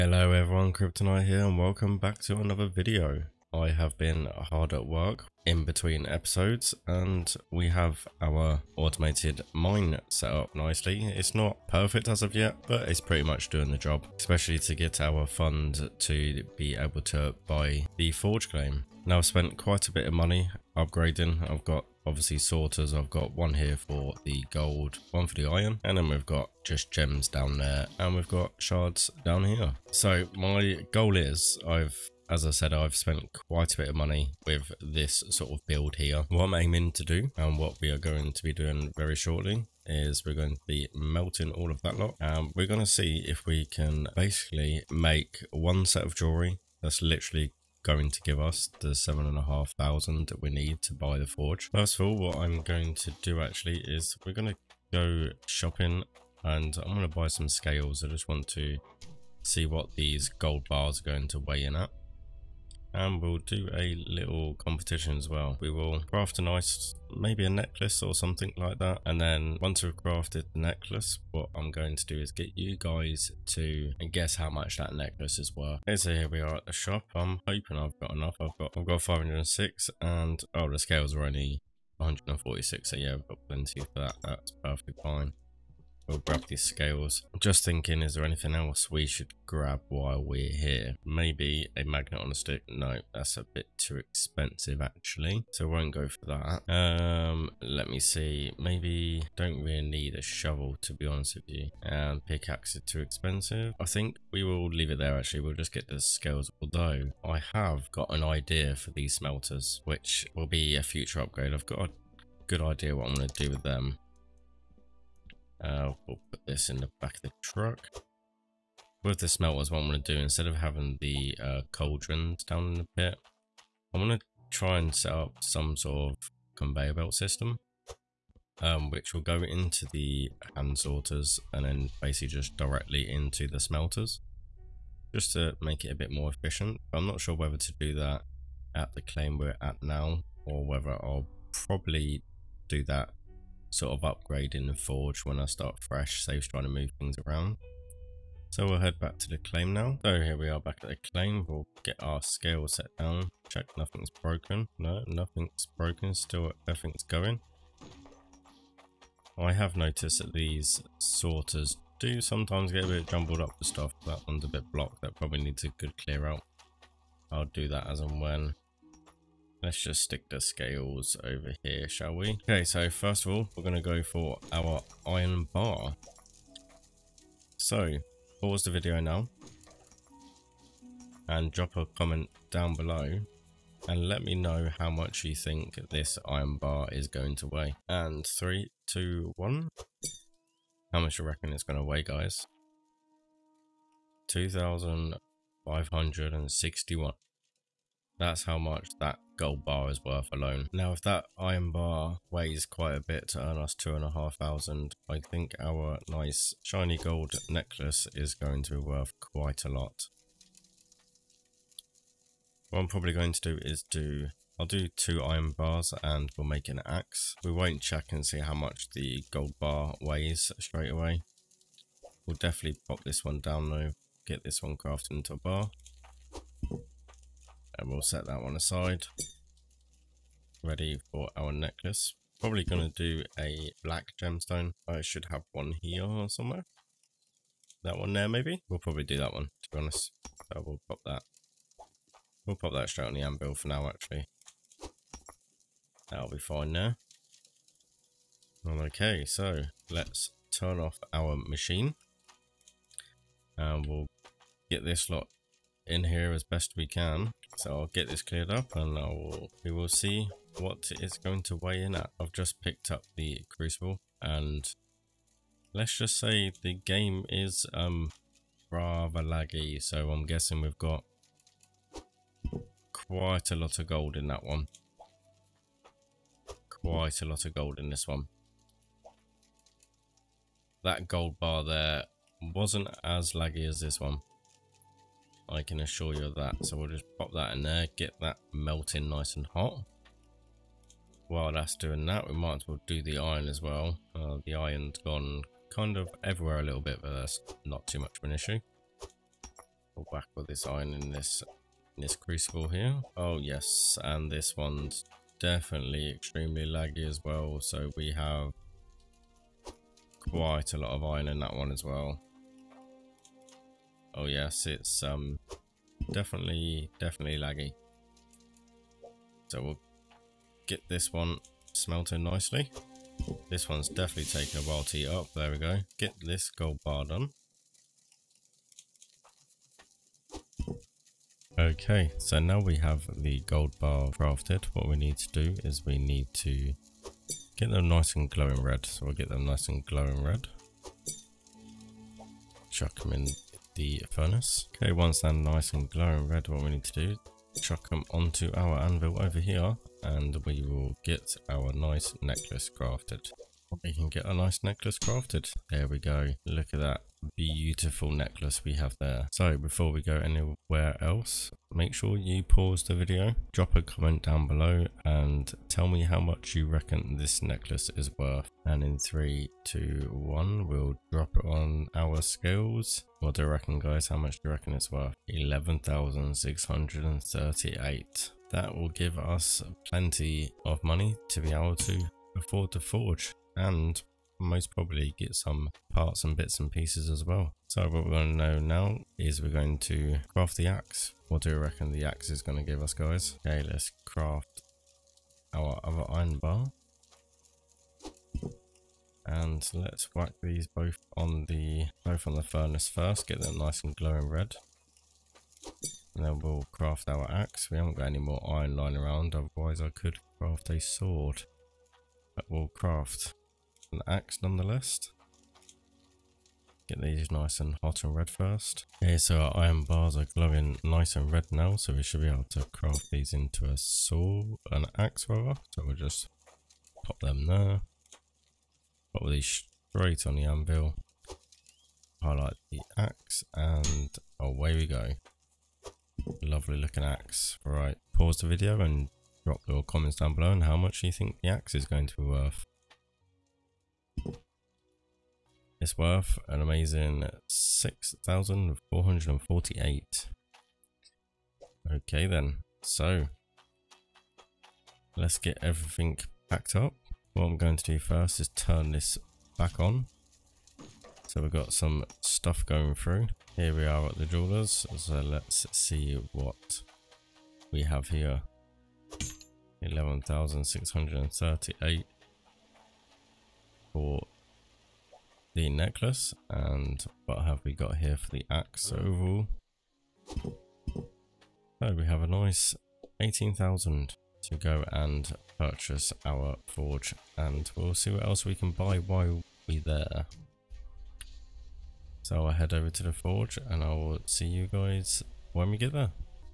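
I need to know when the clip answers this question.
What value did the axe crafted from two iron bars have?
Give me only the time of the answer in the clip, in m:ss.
7:27.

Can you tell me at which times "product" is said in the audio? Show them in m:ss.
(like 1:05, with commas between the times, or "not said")
not said.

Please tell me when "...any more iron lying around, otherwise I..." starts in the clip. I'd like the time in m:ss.
6:48.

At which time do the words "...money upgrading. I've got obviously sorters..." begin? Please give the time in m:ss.
0:20.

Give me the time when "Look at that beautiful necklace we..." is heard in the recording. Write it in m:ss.
5:56.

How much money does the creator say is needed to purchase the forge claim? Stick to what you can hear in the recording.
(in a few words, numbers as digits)
7,500.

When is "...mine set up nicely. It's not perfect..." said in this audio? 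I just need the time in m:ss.
0:09.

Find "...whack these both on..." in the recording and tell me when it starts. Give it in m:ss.
6:40.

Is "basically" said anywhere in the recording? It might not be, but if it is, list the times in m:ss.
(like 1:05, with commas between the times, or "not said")
0:44, 2:12.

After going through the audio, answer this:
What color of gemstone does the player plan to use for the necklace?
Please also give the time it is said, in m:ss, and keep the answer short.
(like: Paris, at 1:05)
Black, at 3:53.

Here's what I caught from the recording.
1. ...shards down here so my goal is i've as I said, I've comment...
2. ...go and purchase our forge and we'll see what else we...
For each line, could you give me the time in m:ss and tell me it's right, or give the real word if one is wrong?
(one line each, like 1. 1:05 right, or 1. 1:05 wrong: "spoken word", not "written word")
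1. 0:28 wrong: "spent", not "comment"
2. 8:04 right.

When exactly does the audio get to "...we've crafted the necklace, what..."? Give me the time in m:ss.
1:09.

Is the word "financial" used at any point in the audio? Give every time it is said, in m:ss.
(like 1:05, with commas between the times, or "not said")
not said.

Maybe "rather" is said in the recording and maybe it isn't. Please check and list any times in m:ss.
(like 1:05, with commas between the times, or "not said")
4:28, 7:05.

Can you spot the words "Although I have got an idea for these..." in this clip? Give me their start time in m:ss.
1:46.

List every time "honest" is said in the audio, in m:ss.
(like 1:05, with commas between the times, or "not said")
1:41, 3:59.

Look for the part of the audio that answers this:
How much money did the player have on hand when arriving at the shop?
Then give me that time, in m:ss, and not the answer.
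1:19.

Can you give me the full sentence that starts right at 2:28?
So we'll head back to the claim now.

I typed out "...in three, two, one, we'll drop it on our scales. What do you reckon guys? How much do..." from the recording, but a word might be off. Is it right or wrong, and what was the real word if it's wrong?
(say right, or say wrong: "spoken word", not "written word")
right.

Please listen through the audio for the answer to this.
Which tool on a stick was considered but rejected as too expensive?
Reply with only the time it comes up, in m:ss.
1:31.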